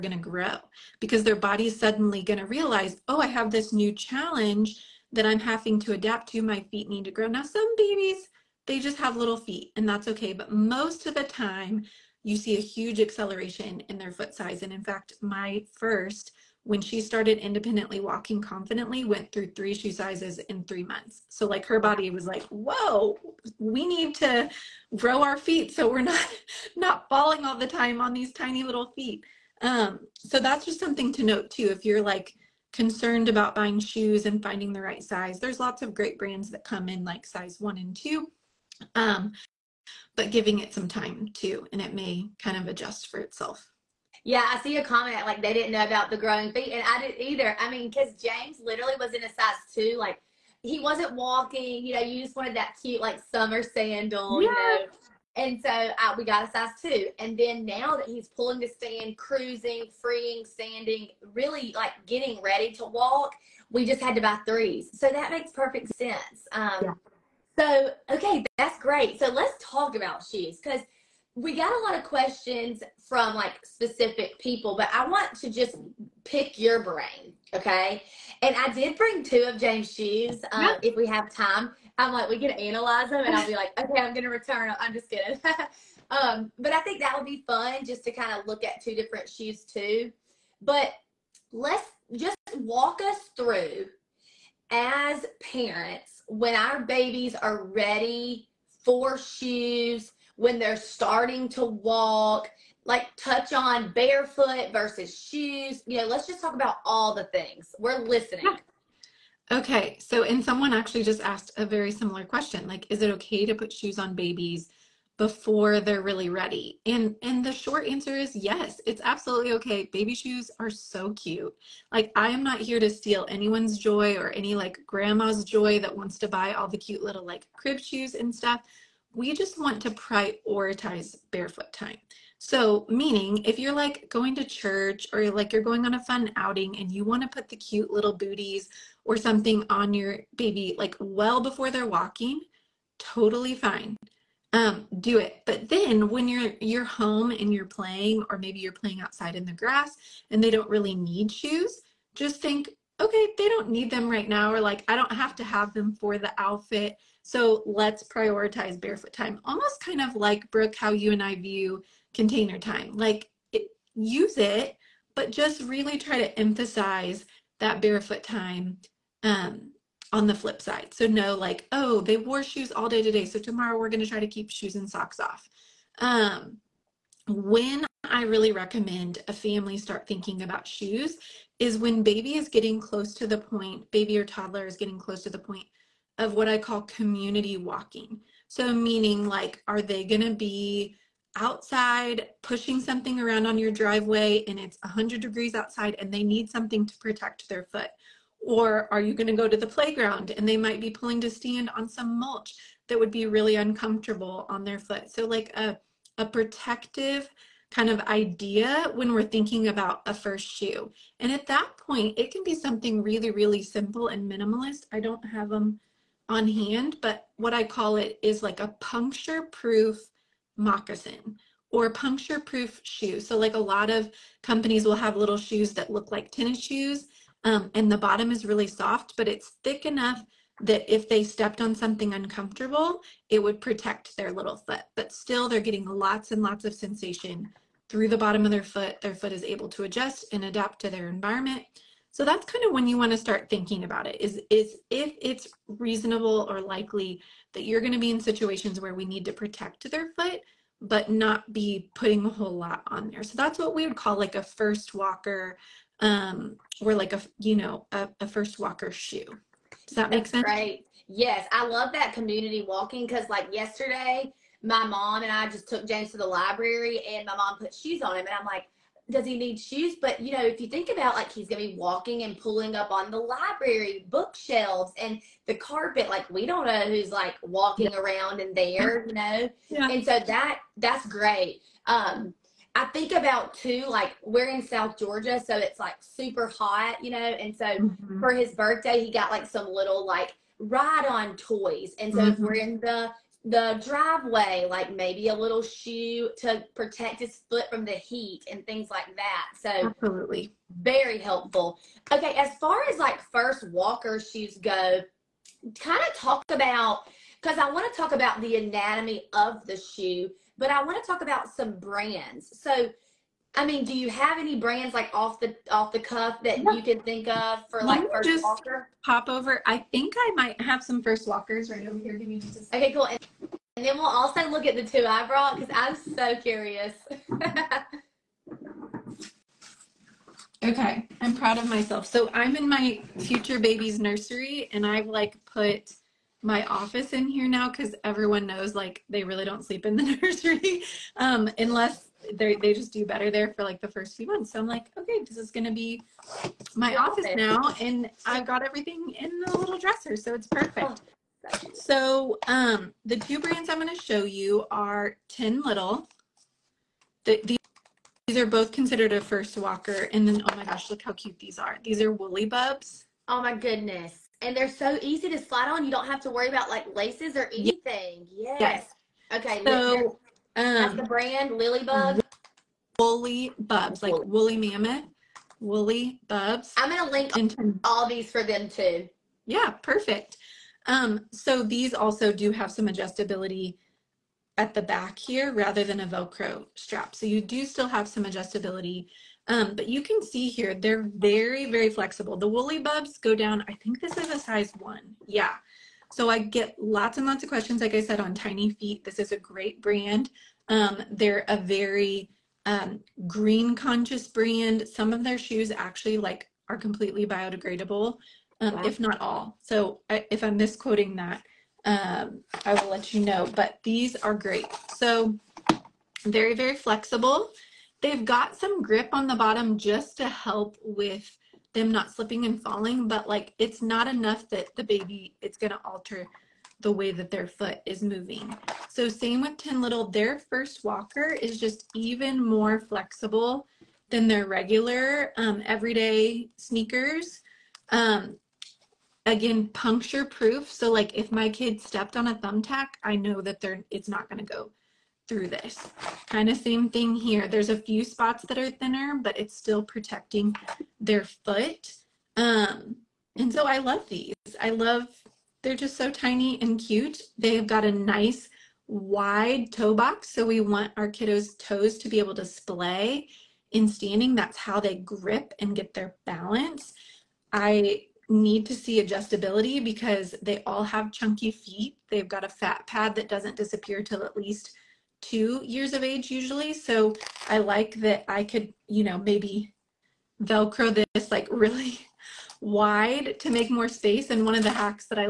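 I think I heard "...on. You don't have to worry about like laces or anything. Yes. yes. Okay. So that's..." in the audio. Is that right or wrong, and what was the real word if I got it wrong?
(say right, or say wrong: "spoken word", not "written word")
right.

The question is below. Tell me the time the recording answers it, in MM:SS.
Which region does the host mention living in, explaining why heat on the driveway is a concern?
04:44.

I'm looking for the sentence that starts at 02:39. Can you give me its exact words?
Almost kind of like Brooke, how you and I view container time.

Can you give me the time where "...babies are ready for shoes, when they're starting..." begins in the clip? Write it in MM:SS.
01:36.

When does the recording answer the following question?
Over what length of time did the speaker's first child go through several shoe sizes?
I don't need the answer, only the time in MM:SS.
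00:20.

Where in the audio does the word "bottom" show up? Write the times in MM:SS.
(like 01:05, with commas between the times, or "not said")
03:47, 03:58, 06:59.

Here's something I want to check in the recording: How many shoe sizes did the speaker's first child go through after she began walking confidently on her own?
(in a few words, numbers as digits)
3.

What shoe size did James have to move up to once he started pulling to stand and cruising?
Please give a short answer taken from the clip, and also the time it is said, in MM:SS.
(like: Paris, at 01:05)
3, at 01:04.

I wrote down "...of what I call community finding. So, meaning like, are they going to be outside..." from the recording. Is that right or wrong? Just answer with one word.
wrong.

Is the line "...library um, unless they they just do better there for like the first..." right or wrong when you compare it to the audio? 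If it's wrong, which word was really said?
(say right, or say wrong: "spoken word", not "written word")
wrong: "nursery", not "library".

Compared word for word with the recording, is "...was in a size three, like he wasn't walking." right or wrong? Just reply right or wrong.
wrong.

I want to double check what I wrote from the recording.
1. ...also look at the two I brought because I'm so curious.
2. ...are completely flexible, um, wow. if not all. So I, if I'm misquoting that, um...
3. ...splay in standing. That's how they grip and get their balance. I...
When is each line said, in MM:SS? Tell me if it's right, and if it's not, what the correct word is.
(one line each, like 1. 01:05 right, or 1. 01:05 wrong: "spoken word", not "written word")
1. 05:24 right
2. 06:46 wrong: "biodegradable", not "flexible"
3. 07:42 right.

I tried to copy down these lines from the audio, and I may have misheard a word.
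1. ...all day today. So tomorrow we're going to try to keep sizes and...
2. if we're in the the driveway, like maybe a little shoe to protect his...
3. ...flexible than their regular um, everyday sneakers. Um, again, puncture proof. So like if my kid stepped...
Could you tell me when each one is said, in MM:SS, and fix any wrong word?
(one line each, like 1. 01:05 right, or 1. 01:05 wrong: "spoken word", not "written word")
1. 02:52 wrong: "shoes", not "sizes"
2. 04:52 right
3. 07:12 right.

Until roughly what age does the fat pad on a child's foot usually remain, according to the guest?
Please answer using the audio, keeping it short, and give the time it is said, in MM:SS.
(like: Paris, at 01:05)
2 years, at 07:55.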